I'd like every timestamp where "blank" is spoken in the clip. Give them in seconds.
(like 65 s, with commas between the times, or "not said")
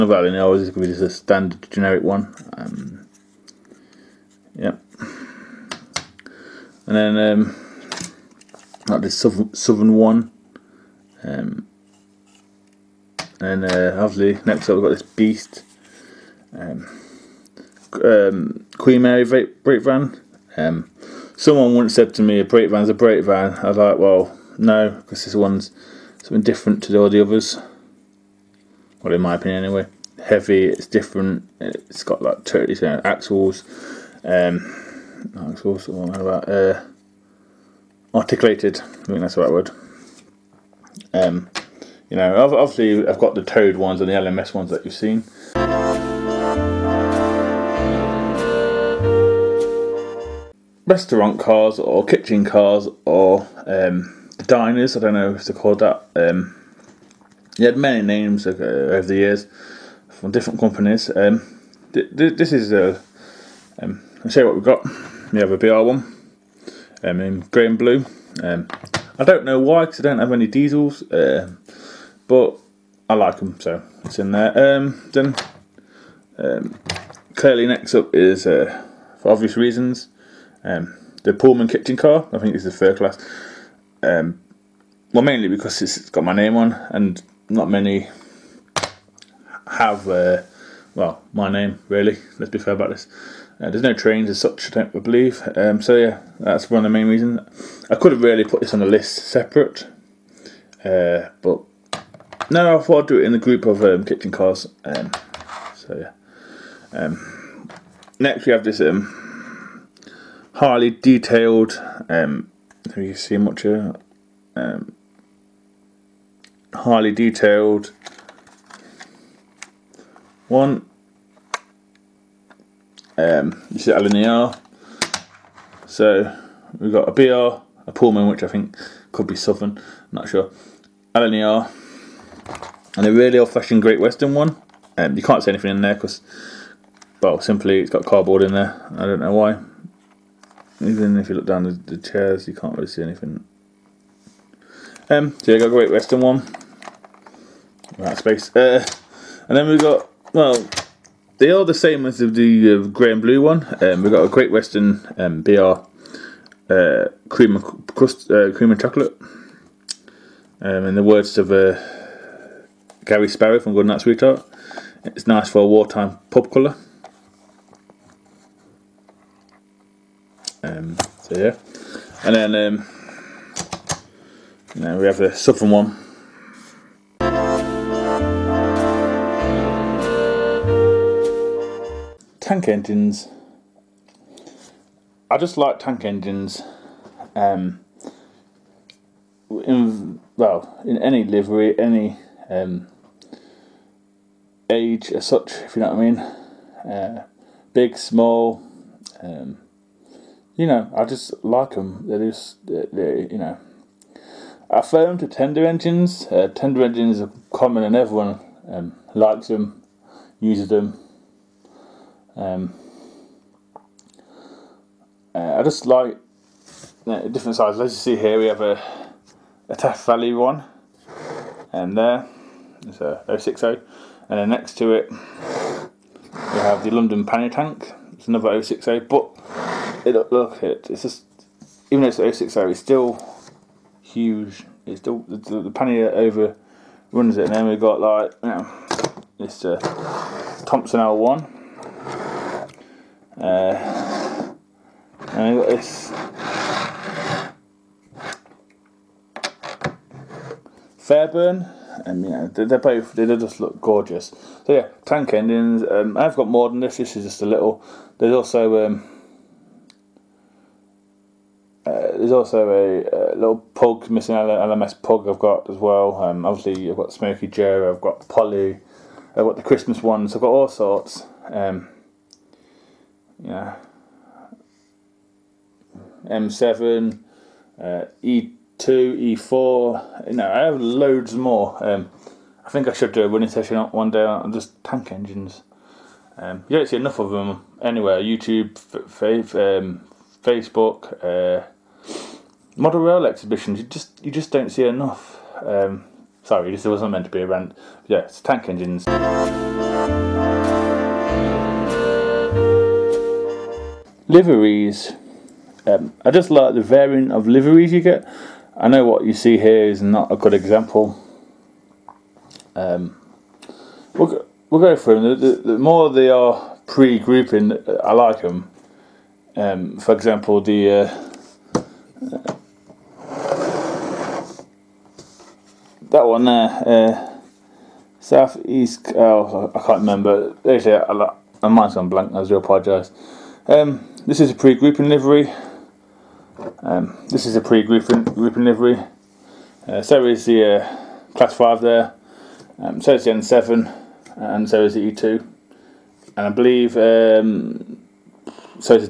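332 s.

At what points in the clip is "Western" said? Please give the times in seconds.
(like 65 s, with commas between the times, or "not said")
133 s, 145 s, 154 s.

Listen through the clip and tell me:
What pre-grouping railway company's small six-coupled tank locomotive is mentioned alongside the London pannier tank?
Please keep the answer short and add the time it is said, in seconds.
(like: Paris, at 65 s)
Taff Vale, at 219 s.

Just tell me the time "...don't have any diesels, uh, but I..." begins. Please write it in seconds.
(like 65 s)
70 s.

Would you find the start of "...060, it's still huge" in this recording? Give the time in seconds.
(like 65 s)
232 s.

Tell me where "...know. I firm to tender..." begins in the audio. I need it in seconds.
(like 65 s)
203 s.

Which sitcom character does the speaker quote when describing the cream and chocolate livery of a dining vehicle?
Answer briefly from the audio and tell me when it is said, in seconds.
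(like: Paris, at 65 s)
Gary Sparrow, at 163 s.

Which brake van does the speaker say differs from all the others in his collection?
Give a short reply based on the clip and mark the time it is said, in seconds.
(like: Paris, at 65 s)
Queen Mary, at 18 s.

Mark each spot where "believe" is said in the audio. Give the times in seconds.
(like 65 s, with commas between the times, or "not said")
95 s, 346 s.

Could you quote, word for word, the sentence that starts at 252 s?
And uh, you they're both, they just look gorgeous.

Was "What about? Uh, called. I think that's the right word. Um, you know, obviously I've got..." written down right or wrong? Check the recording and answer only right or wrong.
wrong.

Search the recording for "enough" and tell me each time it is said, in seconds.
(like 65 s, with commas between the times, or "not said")
286 s, 294 s.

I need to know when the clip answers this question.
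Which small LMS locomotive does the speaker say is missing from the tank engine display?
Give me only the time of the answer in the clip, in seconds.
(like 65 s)
264 s.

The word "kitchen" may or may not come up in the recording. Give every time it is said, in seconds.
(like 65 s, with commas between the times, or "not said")
52 s, 81 s, 104 s.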